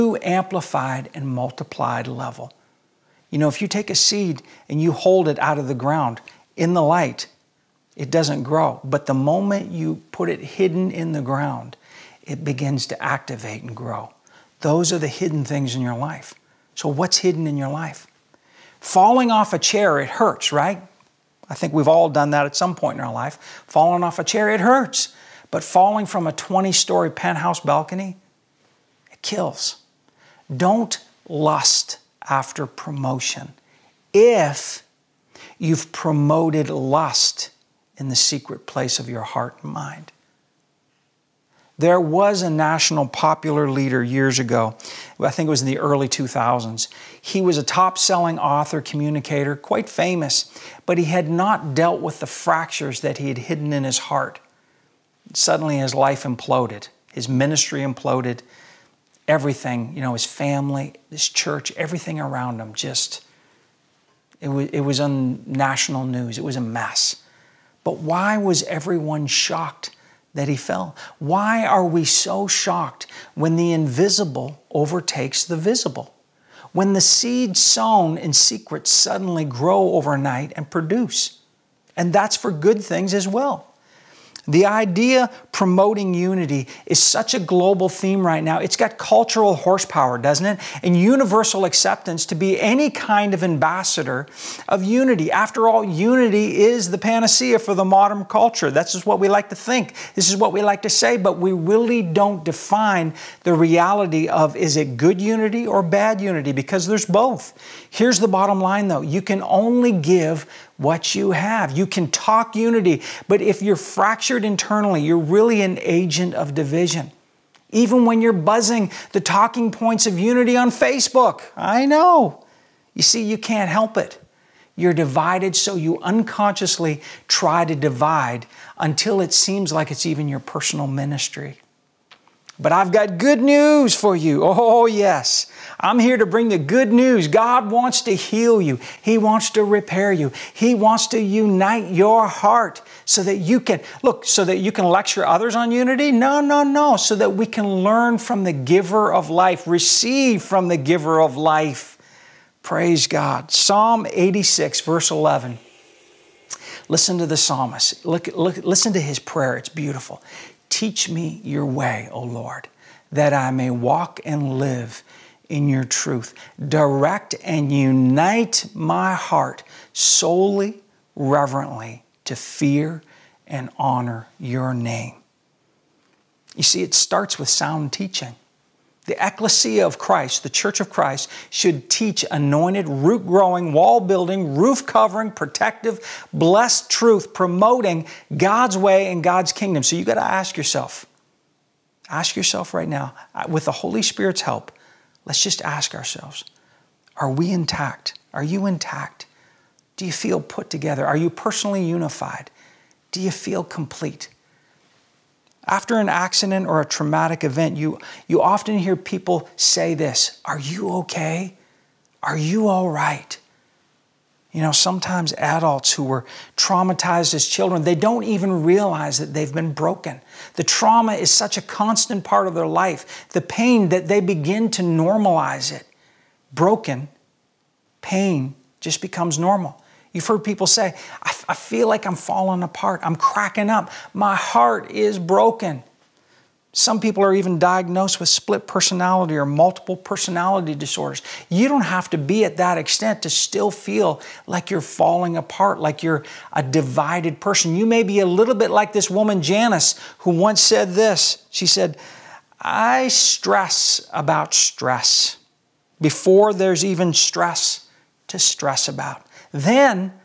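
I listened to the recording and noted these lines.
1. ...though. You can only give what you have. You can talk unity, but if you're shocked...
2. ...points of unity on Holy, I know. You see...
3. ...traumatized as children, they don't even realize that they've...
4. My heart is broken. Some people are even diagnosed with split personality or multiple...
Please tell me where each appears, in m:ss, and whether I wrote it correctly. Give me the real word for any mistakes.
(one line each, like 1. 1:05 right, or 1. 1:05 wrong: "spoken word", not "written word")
1. 1:48 wrong: "fractured", not "shocked"
2. 1:59 wrong: "Facebook", not "Holy"
3. 3:36 right
4. 3:54 right.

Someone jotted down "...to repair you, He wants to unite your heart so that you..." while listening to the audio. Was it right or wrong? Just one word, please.
right.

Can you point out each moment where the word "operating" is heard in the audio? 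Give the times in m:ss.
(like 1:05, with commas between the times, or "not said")
not said.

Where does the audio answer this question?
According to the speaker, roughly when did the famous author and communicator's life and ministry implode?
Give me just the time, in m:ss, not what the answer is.
0:45.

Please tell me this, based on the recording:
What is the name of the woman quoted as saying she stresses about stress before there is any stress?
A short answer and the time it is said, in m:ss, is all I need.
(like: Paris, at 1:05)
Janice, at 4:09.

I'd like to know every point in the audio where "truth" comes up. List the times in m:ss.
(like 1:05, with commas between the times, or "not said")
2:45, 3:06.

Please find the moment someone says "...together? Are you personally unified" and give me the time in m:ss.
3:20.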